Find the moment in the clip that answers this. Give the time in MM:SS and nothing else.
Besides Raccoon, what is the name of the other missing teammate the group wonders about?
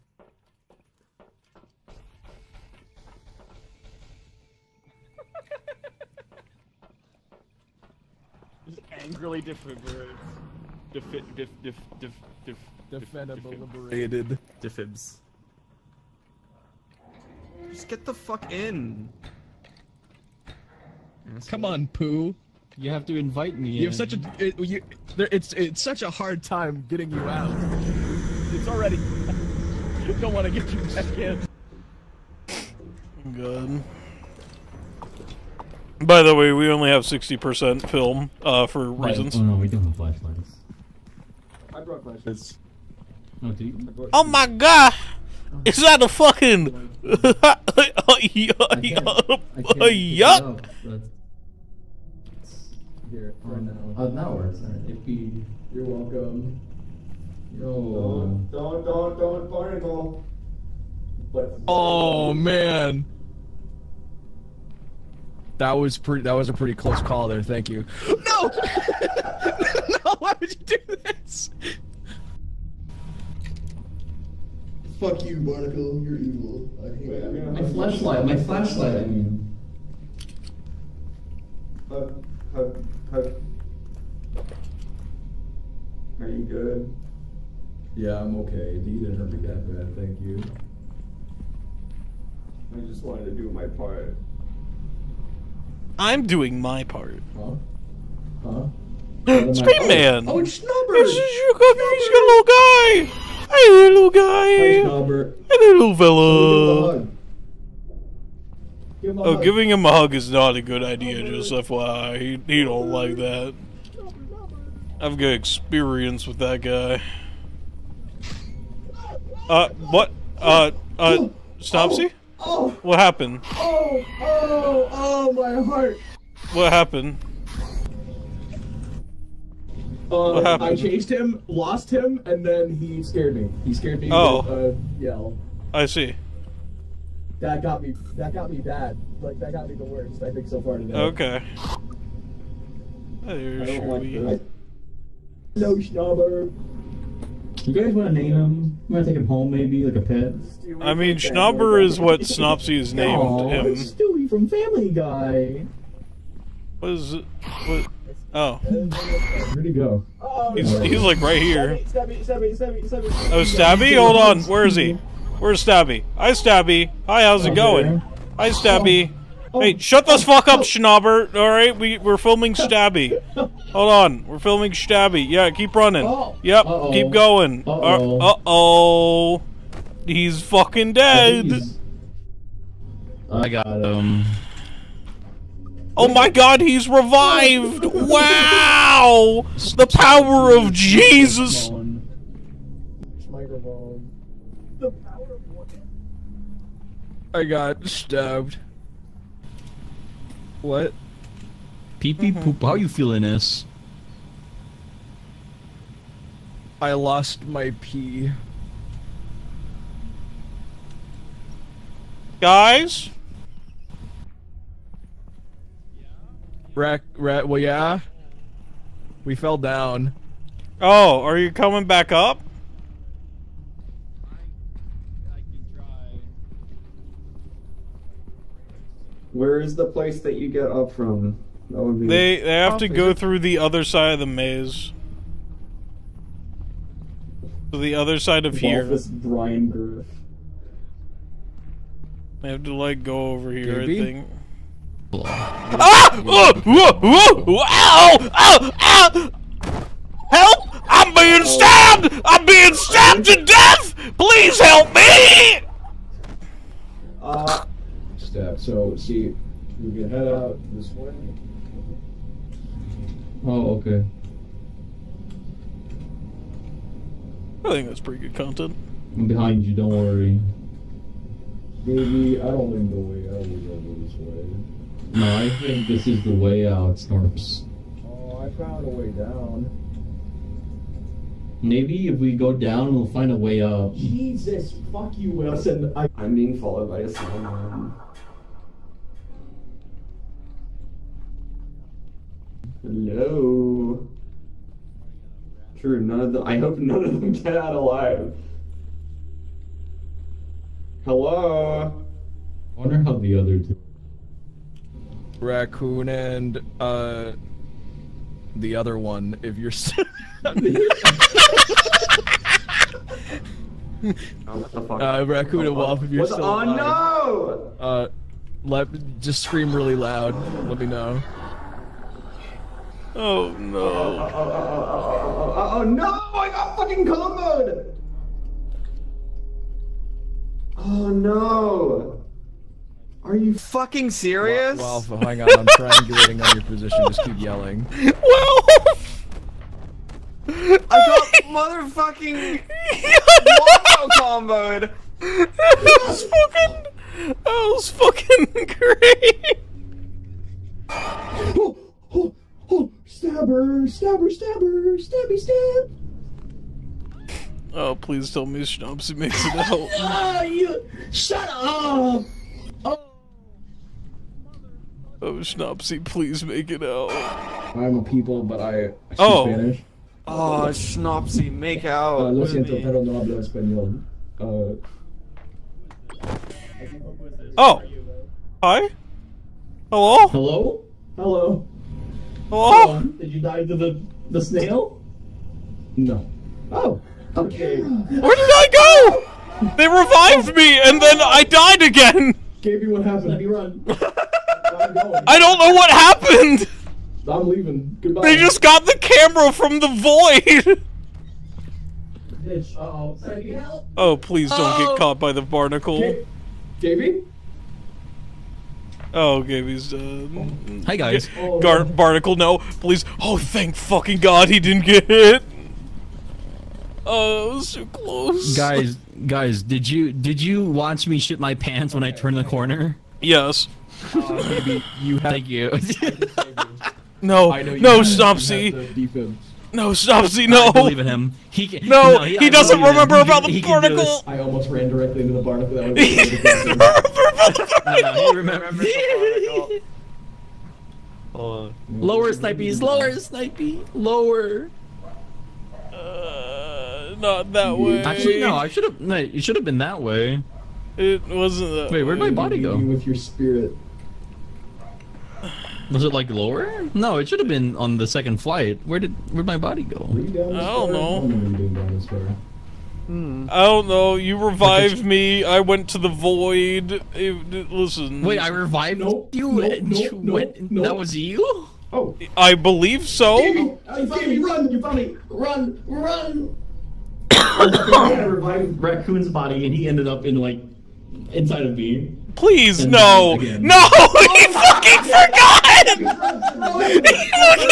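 05:15.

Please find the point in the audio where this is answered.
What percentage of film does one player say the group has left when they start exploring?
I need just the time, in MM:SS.
00:37.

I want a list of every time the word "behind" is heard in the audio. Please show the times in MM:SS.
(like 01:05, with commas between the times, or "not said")
04:29.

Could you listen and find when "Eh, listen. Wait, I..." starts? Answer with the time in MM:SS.
07:47.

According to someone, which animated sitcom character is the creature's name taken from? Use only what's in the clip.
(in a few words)
Stewie.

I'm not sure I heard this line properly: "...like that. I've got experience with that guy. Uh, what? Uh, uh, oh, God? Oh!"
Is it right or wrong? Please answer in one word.
wrong.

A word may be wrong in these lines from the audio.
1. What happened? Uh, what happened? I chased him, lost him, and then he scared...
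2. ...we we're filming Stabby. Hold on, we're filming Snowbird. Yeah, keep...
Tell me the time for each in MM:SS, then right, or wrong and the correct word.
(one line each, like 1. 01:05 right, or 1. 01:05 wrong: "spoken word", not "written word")
1. 02:06 right
2. 02:51 wrong: "Stabby", not "Snowbird".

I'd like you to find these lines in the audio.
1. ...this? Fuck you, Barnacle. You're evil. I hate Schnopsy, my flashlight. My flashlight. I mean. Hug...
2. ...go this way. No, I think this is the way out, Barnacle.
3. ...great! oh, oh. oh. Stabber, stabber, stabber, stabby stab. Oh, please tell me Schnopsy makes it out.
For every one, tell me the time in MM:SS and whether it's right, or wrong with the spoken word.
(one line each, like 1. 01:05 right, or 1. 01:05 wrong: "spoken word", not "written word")
1. 01:11 wrong: "Wait", not "Schnopsy"
2. 04:33 wrong: "Storms", not "Barnacle"
3. 05:48 right.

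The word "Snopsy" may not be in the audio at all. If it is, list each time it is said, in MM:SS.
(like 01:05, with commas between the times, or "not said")
02:01, 02:32.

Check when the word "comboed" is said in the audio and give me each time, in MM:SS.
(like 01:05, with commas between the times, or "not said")
05:27, 05:44.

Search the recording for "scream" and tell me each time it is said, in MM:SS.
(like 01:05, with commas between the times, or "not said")
01:39, 05:19.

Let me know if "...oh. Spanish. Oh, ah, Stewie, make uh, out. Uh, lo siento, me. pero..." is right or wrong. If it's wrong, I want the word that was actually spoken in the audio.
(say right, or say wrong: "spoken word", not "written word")
wrong: "Schnopsy", not "Stewie".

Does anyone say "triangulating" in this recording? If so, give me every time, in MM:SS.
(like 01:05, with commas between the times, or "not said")
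05:35.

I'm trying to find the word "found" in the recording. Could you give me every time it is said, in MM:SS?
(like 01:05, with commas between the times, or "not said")
04:38, 07:54.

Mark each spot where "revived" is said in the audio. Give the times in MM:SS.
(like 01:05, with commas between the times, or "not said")
03:06, 06:29, 07:44, 07:48, 07:58.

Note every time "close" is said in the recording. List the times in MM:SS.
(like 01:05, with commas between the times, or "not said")
01:06, 06:57.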